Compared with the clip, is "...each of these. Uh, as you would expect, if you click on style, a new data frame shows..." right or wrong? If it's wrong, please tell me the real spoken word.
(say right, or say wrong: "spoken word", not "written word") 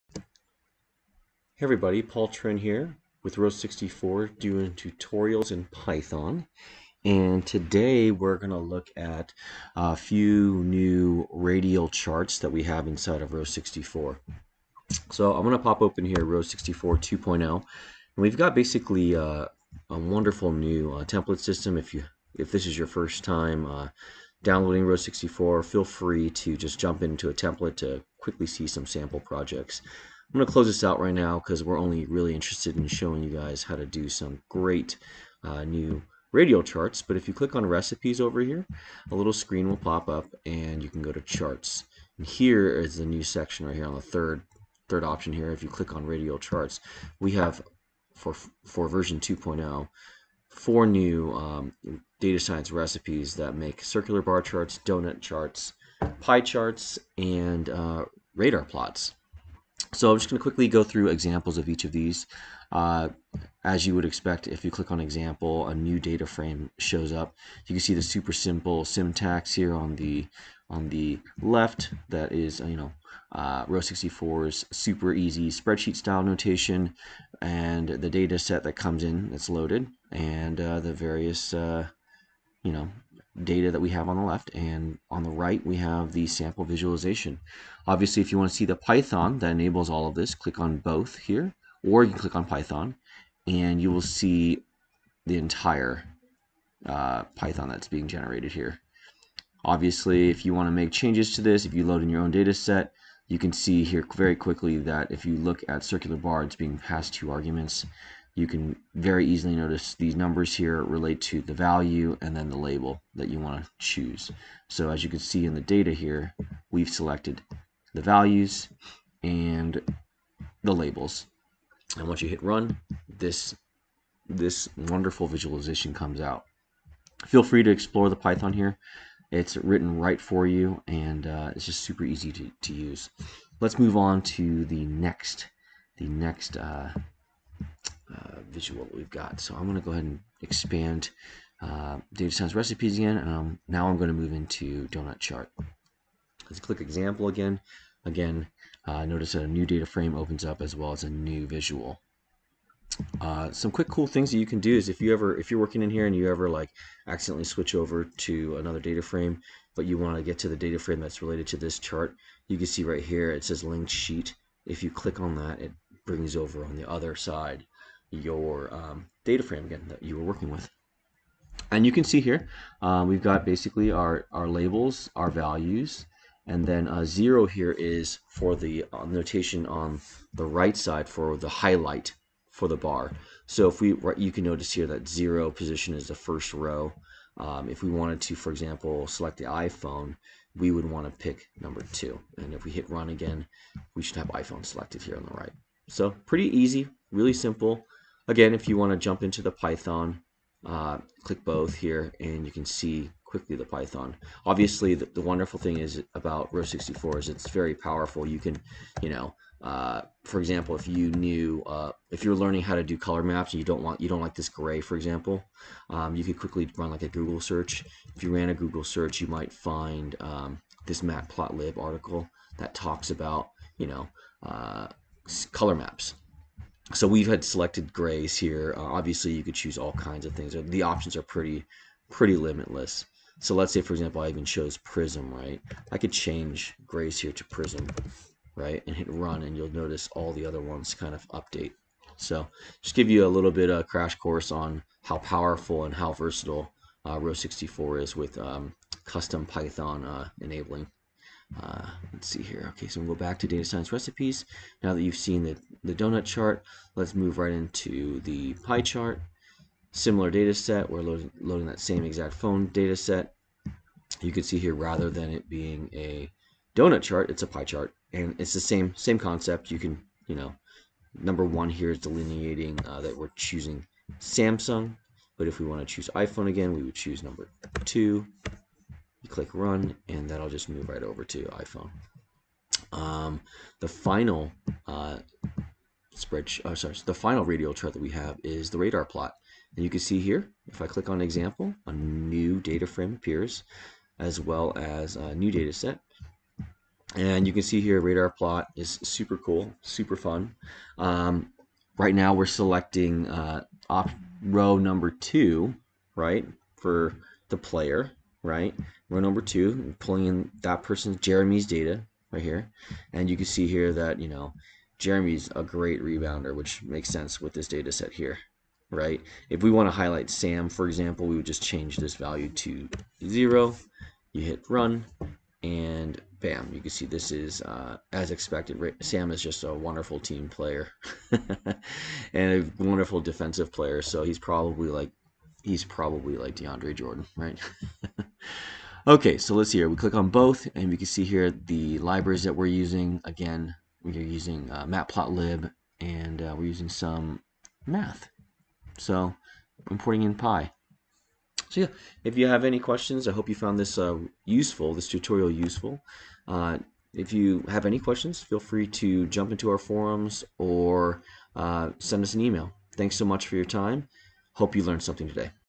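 wrong: "example", not "style".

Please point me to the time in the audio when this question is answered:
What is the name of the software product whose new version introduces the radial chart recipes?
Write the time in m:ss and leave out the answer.
0:16.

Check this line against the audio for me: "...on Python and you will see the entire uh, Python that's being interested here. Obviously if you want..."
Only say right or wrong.
wrong.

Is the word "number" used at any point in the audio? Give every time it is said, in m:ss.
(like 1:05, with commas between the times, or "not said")
1:50, 3:11, 4:31, 4:37, 5:04, 5:09.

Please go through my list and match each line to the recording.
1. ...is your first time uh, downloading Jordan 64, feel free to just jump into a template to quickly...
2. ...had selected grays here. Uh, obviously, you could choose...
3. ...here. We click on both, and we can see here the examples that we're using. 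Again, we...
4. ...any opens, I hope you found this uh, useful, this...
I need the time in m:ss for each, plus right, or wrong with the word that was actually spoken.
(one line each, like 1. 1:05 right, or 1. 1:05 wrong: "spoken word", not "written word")
1. 0:22 wrong: "Row", not "Jordan"
2. 3:47 right
3. 5:39 wrong: "libraries", not "examples"
4. 5:52 wrong: "questions", not "opens".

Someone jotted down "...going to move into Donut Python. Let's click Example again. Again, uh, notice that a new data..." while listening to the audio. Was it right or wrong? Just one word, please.
wrong.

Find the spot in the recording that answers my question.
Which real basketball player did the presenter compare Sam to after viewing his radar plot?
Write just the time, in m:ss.
5:36.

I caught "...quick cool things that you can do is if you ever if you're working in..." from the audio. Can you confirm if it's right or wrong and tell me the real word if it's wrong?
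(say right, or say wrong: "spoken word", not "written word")
right.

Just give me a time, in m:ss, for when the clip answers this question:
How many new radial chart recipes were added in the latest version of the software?
0:50.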